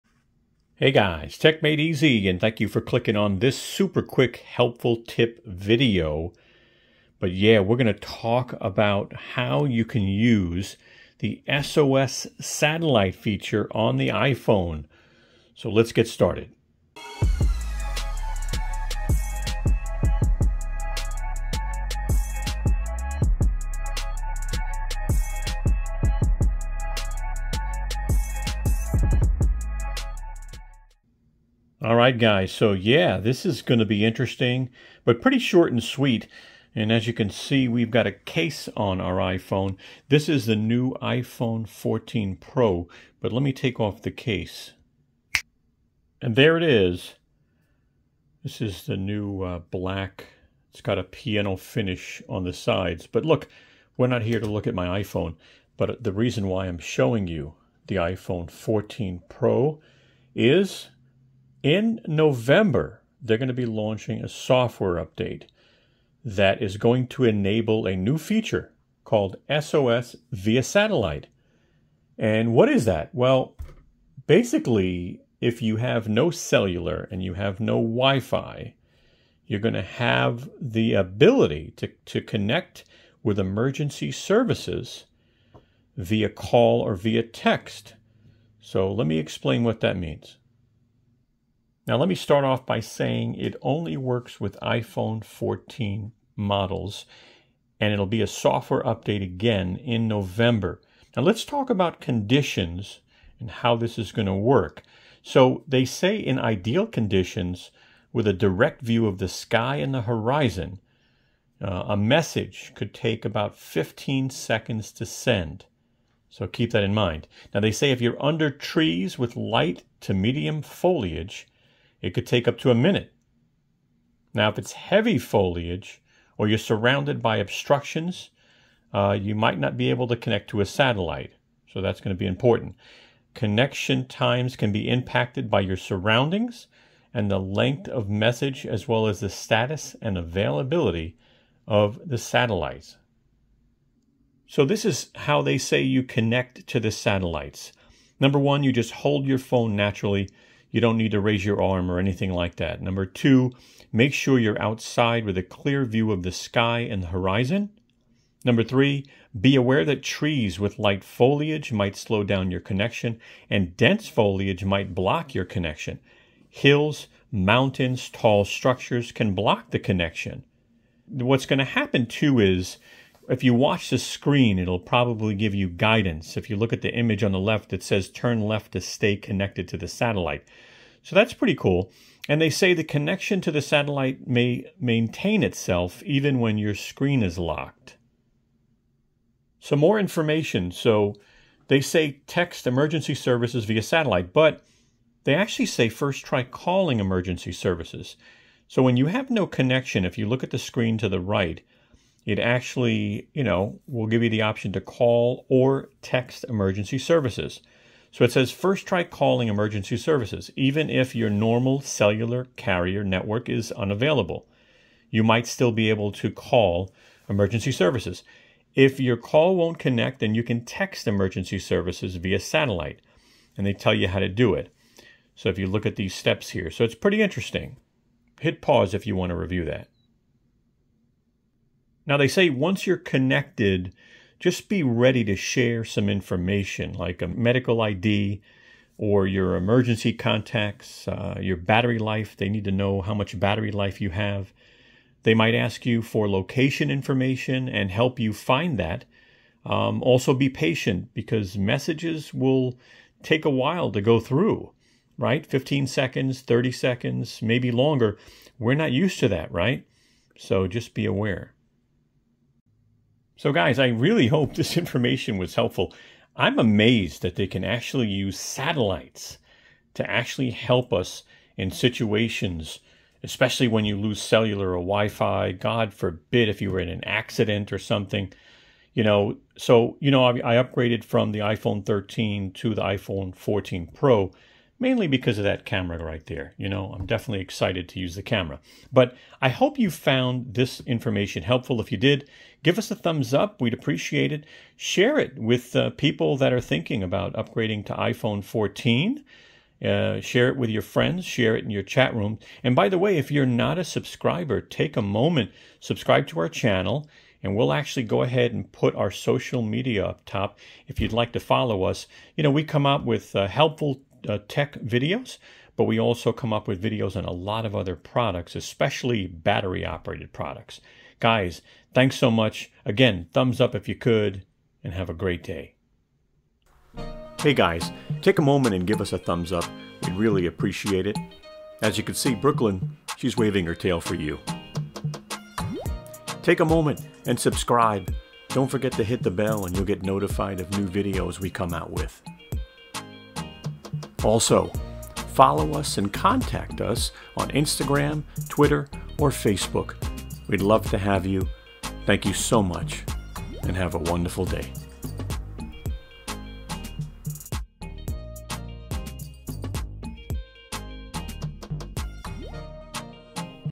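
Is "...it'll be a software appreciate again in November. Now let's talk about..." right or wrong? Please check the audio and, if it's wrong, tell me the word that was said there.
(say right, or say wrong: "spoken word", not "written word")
wrong: "update", not "appreciate".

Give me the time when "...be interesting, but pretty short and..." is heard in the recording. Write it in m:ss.
0:33.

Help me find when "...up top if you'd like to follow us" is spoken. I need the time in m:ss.
5:10.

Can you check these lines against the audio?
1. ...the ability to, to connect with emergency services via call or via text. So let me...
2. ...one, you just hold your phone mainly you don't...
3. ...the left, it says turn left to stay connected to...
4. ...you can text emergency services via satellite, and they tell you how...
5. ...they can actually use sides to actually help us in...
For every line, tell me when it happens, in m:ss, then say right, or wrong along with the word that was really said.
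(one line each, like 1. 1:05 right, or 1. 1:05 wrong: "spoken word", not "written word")
1. 1:20 right
2. 2:28 wrong: "naturally", not "mainly"
3. 2:57 right
4. 3:40 right
5. 4:27 wrong: "satellites", not "sides".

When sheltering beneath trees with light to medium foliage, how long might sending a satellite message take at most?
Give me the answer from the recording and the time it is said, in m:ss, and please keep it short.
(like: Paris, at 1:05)
Up to a minute, at 2:02.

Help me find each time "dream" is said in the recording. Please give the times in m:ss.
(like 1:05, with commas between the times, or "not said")
not said.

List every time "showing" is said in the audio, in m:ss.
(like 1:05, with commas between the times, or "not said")
0:56.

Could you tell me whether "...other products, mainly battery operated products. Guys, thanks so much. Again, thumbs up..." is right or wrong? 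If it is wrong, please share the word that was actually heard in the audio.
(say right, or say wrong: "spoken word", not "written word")
wrong: "especially", not "mainly".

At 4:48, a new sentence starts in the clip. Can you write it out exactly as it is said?
But I hope you found this information helpful.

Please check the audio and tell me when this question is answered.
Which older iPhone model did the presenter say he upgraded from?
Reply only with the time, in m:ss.
4:41.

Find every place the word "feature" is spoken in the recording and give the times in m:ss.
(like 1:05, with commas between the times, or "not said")
0:13, 1:08.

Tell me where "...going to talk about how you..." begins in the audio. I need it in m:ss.
0:07.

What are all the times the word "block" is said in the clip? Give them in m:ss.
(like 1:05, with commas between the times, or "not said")
2:44, 2:49.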